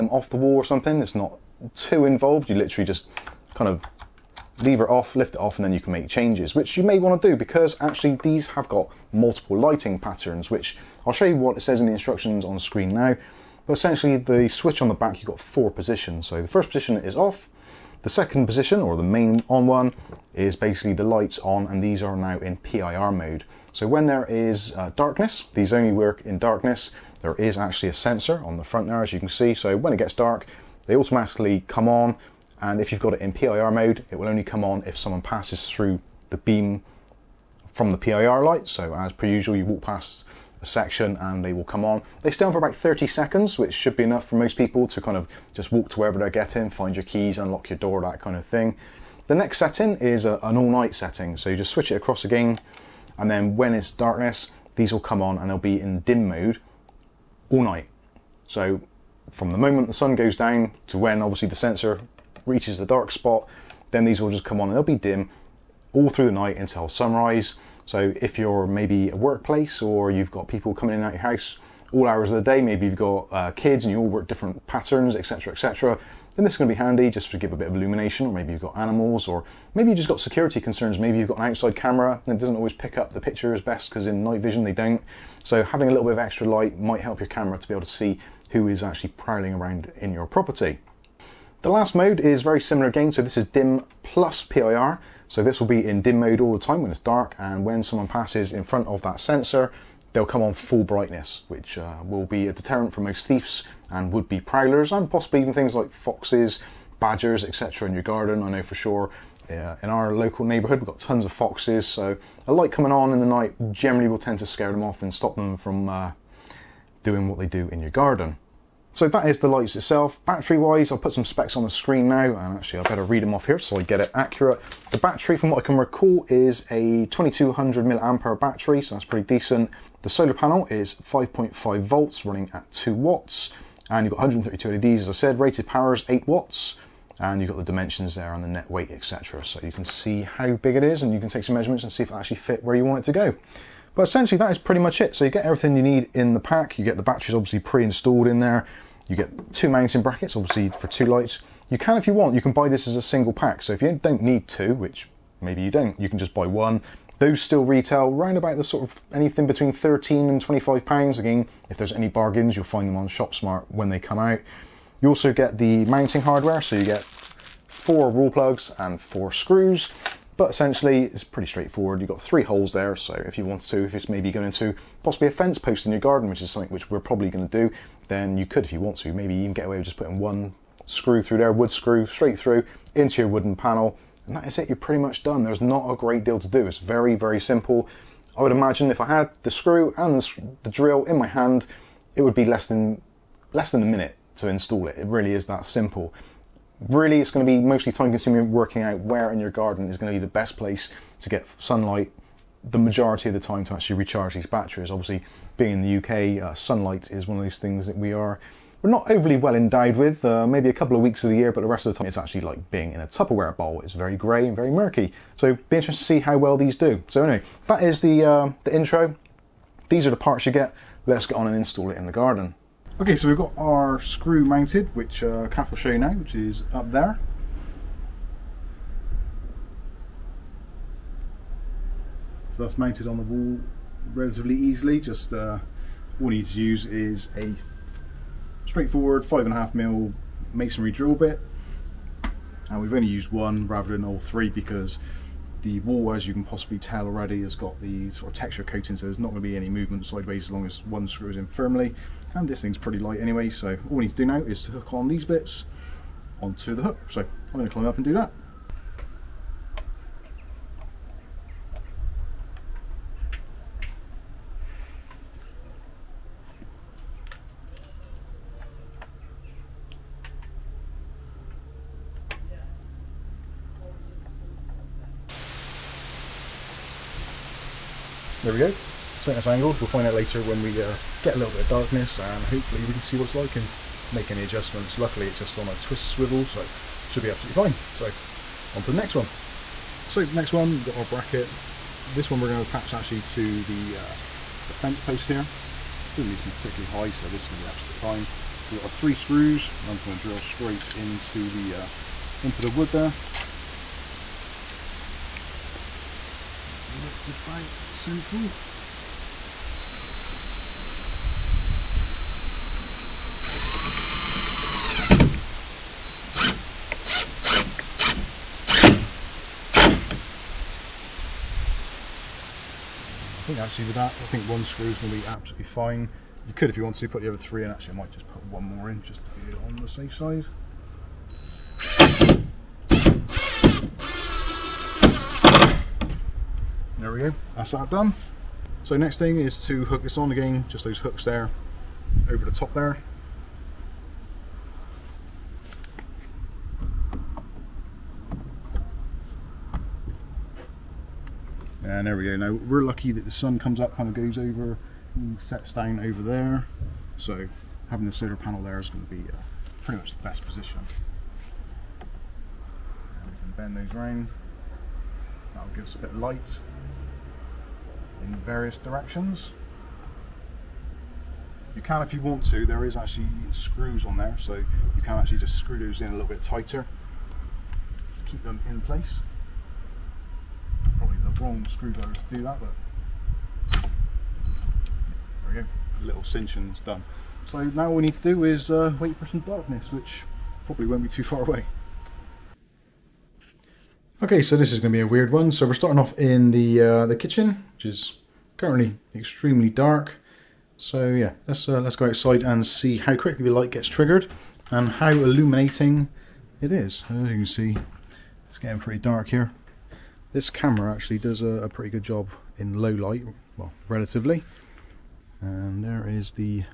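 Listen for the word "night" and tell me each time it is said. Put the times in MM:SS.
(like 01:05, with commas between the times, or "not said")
00:50, 00:57, 01:06, 01:24, 01:53.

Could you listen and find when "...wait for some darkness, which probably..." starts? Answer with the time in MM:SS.
06:28.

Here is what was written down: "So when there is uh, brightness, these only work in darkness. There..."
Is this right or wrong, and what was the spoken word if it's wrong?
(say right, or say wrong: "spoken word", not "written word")
wrong: "darkness", not "brightness".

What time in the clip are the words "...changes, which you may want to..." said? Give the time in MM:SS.
00:06.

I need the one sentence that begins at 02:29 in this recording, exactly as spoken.
You get two mounting brackets, obviously for two lights.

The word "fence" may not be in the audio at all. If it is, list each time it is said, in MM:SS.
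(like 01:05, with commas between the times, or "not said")
02:55, 04:54.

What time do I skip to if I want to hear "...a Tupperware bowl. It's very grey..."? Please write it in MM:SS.
03:33.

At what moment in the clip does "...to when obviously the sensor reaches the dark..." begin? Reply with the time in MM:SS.
01:00.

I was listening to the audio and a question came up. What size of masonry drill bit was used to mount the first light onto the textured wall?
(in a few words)
5.5mm.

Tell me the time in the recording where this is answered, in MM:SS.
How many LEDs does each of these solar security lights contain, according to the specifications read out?
02:14.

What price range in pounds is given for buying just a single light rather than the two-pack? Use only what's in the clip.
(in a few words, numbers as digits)
13 to 25 pounds.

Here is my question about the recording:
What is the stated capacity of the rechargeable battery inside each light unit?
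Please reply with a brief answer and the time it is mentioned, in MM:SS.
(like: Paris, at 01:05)
2200 milliamp hour, at 02:07.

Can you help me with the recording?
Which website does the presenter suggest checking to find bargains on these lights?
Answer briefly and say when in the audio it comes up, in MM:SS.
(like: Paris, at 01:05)
ShopSmart, at 02:43.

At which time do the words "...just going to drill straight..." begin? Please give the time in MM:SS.
04:59.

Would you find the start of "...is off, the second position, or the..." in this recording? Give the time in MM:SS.
00:16.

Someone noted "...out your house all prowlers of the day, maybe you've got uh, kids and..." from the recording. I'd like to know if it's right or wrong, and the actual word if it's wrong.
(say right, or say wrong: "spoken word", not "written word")
wrong: "hours", not "prowlers".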